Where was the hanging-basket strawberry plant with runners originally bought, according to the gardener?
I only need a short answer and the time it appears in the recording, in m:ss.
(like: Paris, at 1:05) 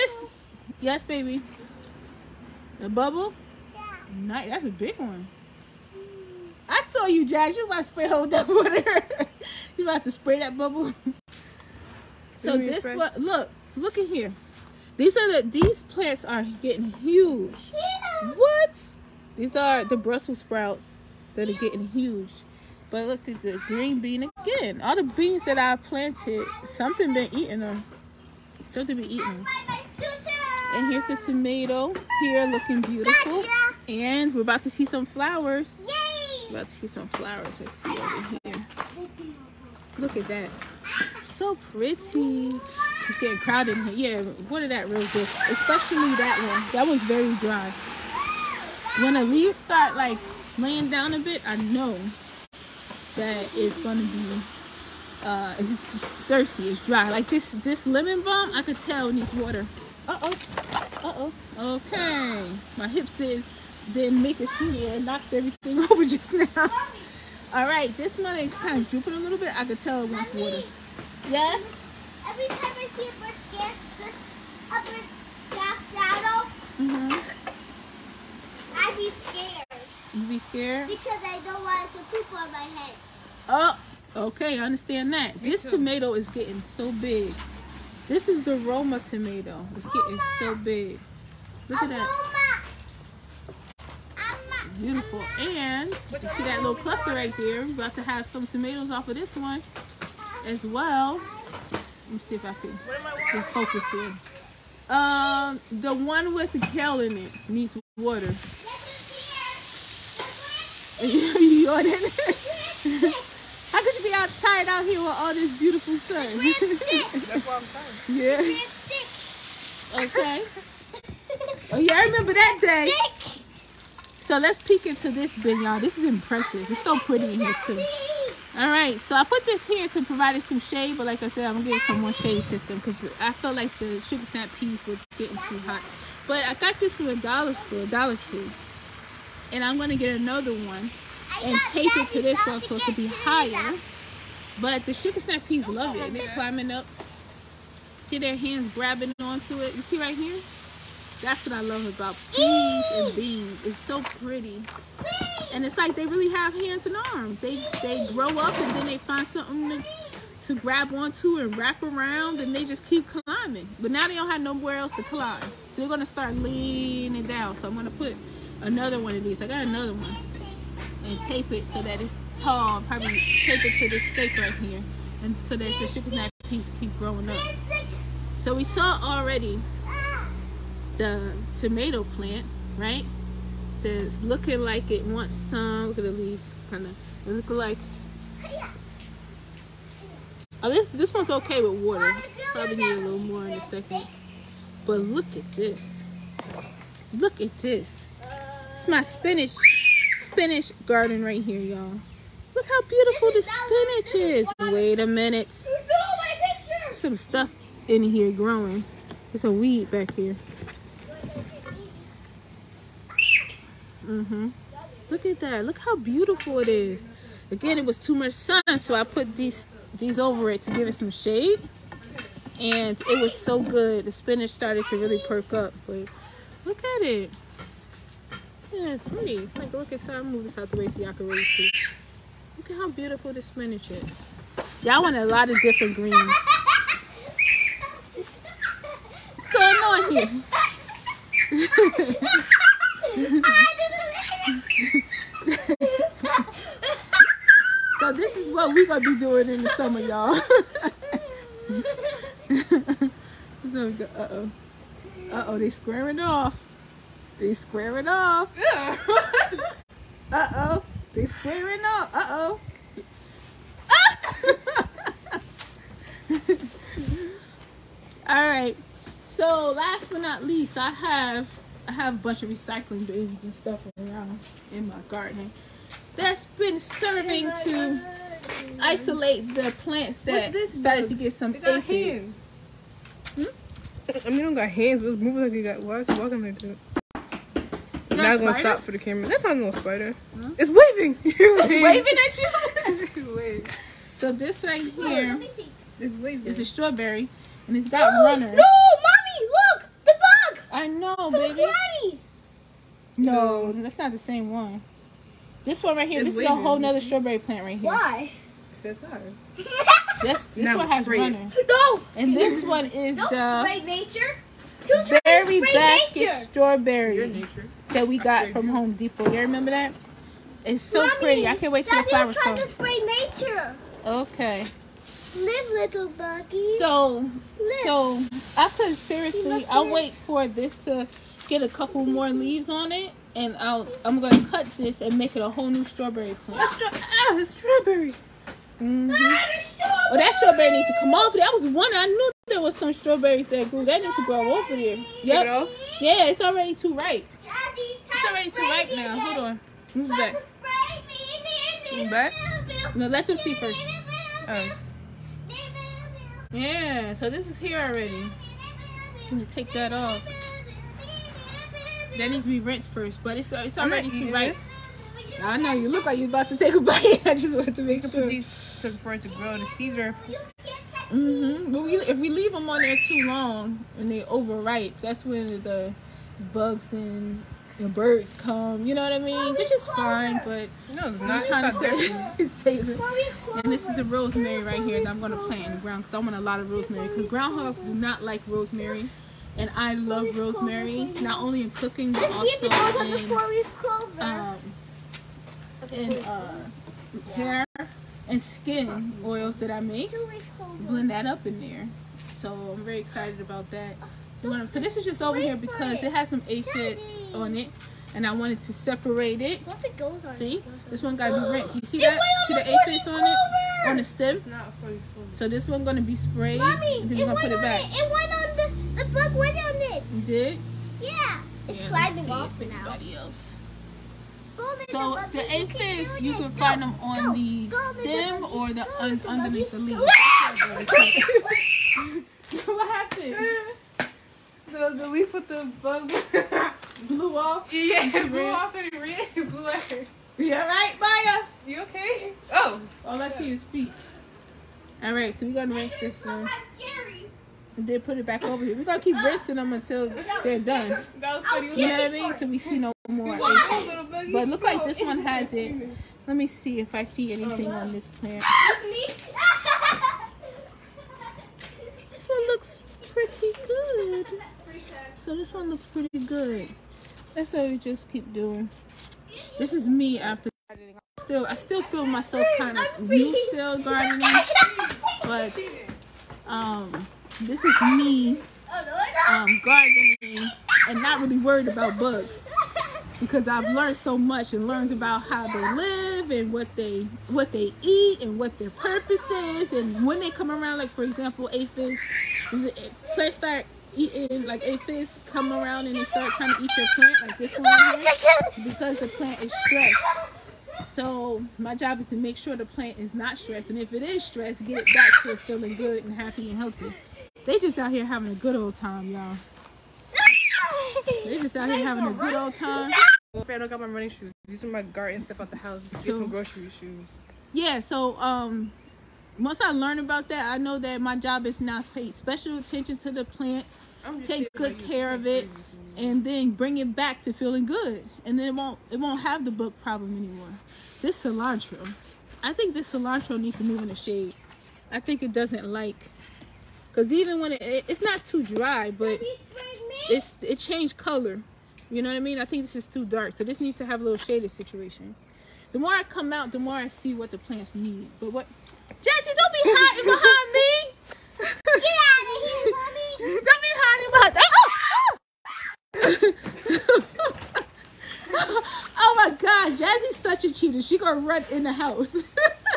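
Home Depot, at 5:18.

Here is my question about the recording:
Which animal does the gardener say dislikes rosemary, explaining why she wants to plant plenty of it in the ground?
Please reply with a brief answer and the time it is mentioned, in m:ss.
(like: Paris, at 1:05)
Groundhogs, at 6:27.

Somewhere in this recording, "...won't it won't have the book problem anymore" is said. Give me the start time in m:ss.
8:48.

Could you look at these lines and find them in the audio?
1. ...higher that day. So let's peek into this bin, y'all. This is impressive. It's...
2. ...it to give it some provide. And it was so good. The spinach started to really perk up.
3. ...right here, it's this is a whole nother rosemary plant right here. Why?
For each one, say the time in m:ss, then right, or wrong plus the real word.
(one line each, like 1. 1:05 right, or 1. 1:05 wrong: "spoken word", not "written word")
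1. 2:02 wrong: "remember", not "higher"
2. 3:40 wrong: "shade", not "provide"
3. 5:05 wrong: "strawberry", not "rosemary".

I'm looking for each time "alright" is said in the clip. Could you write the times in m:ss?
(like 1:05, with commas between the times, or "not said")
1:07, 7:20, 7:25.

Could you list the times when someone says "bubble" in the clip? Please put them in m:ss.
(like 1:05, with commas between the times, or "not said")
0:02, 0:10.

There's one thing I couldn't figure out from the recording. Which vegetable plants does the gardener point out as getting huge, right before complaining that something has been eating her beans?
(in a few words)
Brussels sprouts.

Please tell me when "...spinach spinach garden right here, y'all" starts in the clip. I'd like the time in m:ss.
3:19.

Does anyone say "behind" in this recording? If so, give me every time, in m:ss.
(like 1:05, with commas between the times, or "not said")
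9:10, 9:16.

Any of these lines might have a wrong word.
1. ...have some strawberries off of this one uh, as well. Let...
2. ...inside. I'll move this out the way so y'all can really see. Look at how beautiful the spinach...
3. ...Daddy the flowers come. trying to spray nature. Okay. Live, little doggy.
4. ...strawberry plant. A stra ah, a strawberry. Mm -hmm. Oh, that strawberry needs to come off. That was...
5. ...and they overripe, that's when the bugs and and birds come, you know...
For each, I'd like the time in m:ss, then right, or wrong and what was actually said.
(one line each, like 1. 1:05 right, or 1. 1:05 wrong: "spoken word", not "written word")
1. 1:38 wrong: "tomatoes", not "strawberries"
2. 3:49 right
3. 5:21 right
4. 5:35 right
5. 6:13 right.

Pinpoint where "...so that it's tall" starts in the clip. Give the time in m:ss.
2:51.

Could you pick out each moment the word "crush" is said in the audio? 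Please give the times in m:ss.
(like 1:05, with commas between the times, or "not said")
not said.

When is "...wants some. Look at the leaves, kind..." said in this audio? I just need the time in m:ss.
3:05.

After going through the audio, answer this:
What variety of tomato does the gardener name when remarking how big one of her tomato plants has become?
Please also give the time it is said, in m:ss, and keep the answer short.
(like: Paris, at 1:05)
Roma, at 1:28.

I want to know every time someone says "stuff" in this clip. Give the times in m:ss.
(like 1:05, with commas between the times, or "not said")
3:27, 4:33, 8:35.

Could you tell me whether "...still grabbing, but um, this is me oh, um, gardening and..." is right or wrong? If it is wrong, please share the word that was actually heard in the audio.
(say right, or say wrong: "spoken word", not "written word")
wrong: "gardening", not "grabbing".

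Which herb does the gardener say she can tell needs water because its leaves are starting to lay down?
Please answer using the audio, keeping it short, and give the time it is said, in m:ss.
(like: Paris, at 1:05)
Lemon balm, at 0:57.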